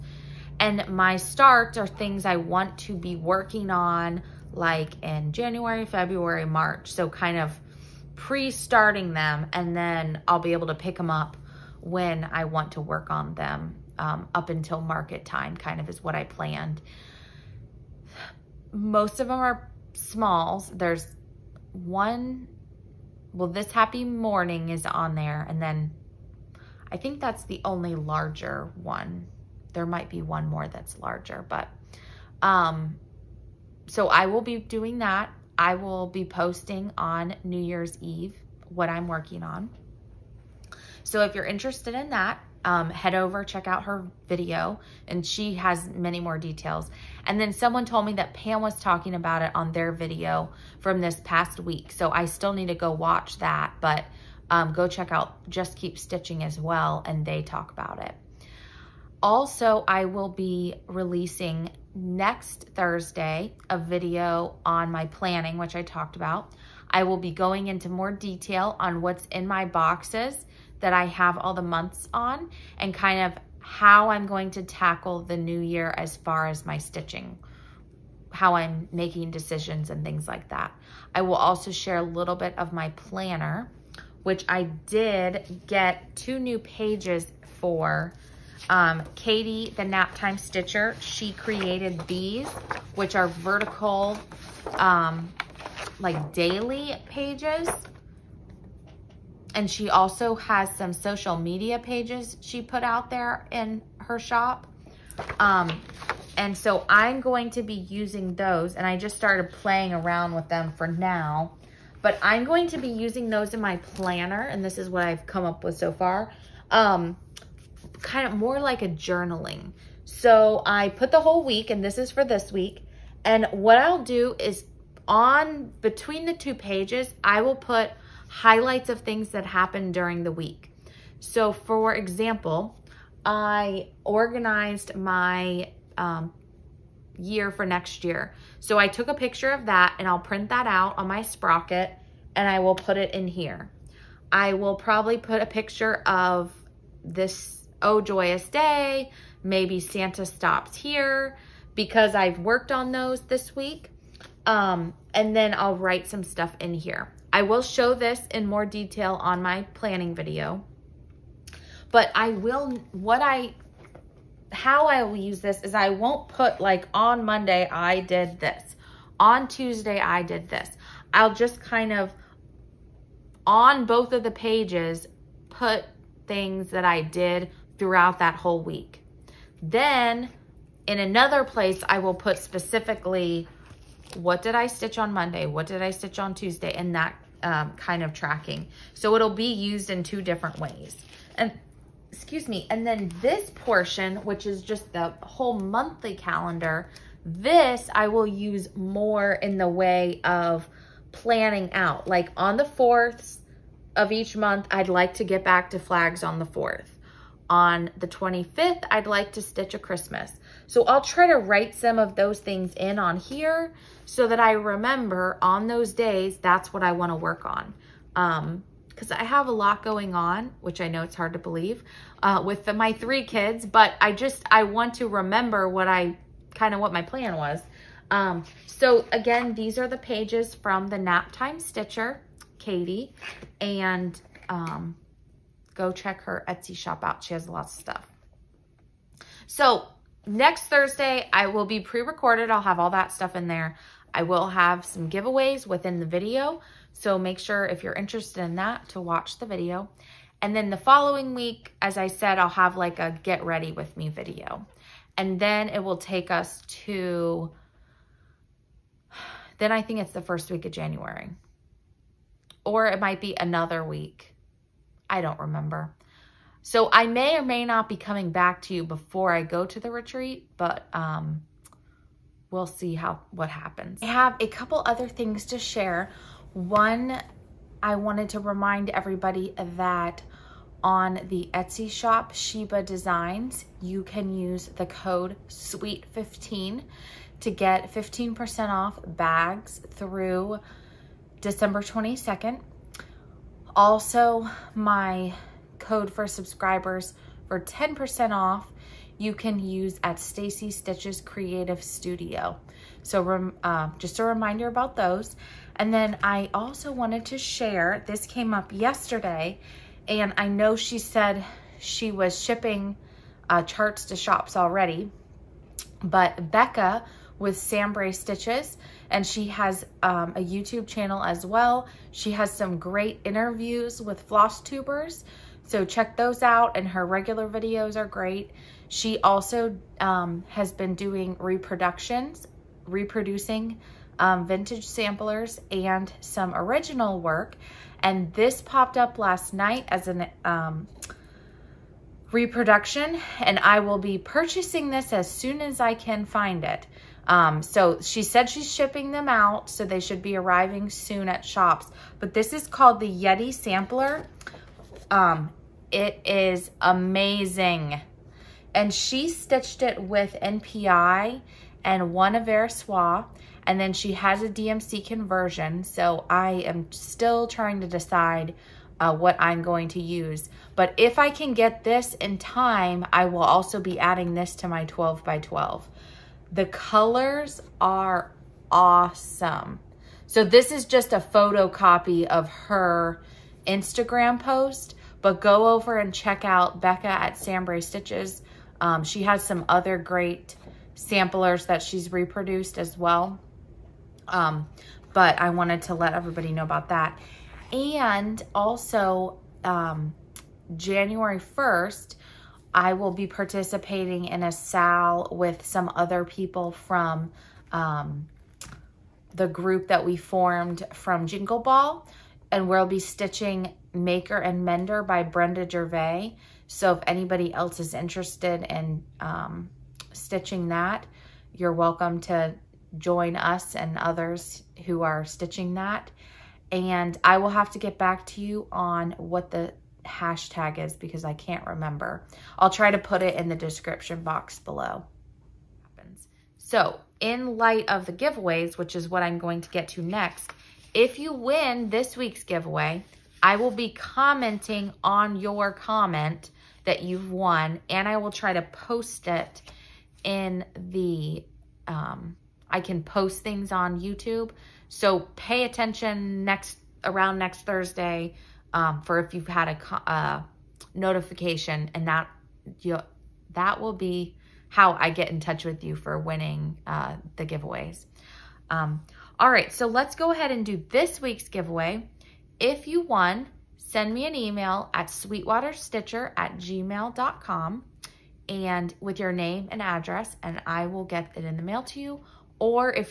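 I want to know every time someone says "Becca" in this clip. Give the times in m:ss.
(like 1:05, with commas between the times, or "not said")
5:16, 6:26.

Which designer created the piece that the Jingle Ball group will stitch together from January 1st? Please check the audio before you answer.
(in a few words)
Brenda Gervais.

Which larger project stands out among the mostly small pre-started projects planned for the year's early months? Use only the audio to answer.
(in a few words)
Happy Morning.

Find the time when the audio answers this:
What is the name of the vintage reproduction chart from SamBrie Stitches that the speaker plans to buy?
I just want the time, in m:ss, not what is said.
5:53.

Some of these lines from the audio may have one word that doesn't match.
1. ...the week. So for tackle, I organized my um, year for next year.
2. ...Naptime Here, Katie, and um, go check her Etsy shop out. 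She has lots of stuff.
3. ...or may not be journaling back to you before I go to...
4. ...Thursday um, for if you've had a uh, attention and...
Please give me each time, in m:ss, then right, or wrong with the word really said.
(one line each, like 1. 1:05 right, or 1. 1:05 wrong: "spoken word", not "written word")
1. 2:10 wrong: "example", not "tackle"
2. 3:50 wrong: "Stitcher", not "Here"
3. 4:27 wrong: "coming", not "journaling"
4. 7:37 wrong: "notification", not "attention".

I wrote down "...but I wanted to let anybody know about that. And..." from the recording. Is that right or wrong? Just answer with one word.
wrong.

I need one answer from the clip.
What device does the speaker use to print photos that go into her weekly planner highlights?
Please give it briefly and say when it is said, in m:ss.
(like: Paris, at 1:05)
Sprocket, at 2:21.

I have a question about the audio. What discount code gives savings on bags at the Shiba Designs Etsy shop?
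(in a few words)
SWEET15.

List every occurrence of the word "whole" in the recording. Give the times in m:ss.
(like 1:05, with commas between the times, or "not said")
2:01, 2:58, 3:15.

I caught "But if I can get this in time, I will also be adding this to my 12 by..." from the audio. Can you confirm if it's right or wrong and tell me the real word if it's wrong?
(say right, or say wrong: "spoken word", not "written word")
right.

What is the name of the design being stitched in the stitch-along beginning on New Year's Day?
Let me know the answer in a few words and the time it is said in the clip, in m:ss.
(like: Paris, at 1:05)
Maker and Mender, at 6:53.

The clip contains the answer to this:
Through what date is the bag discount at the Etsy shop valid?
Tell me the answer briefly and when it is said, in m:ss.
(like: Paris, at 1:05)
December 22nd, at 4:51.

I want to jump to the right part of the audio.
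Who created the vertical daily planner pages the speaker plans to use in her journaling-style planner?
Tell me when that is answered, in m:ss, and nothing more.
1:29.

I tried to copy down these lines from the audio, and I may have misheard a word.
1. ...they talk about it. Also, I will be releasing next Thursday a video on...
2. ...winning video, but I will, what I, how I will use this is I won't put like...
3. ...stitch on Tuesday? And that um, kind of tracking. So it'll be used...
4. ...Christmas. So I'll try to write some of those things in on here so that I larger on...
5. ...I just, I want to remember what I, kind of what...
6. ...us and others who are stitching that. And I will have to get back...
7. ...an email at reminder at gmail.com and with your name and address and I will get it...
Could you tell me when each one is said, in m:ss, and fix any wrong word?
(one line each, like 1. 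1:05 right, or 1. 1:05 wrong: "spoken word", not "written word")
1. 0:57 right
2. 2:39 wrong: "planning", not "winning"
3. 3:05 right
4. 3:29 wrong: "remember", not "larger"
5. 3:43 right
6. 7:03 right
7. 7:54 wrong: "sweetwaterstitcher", not "reminder".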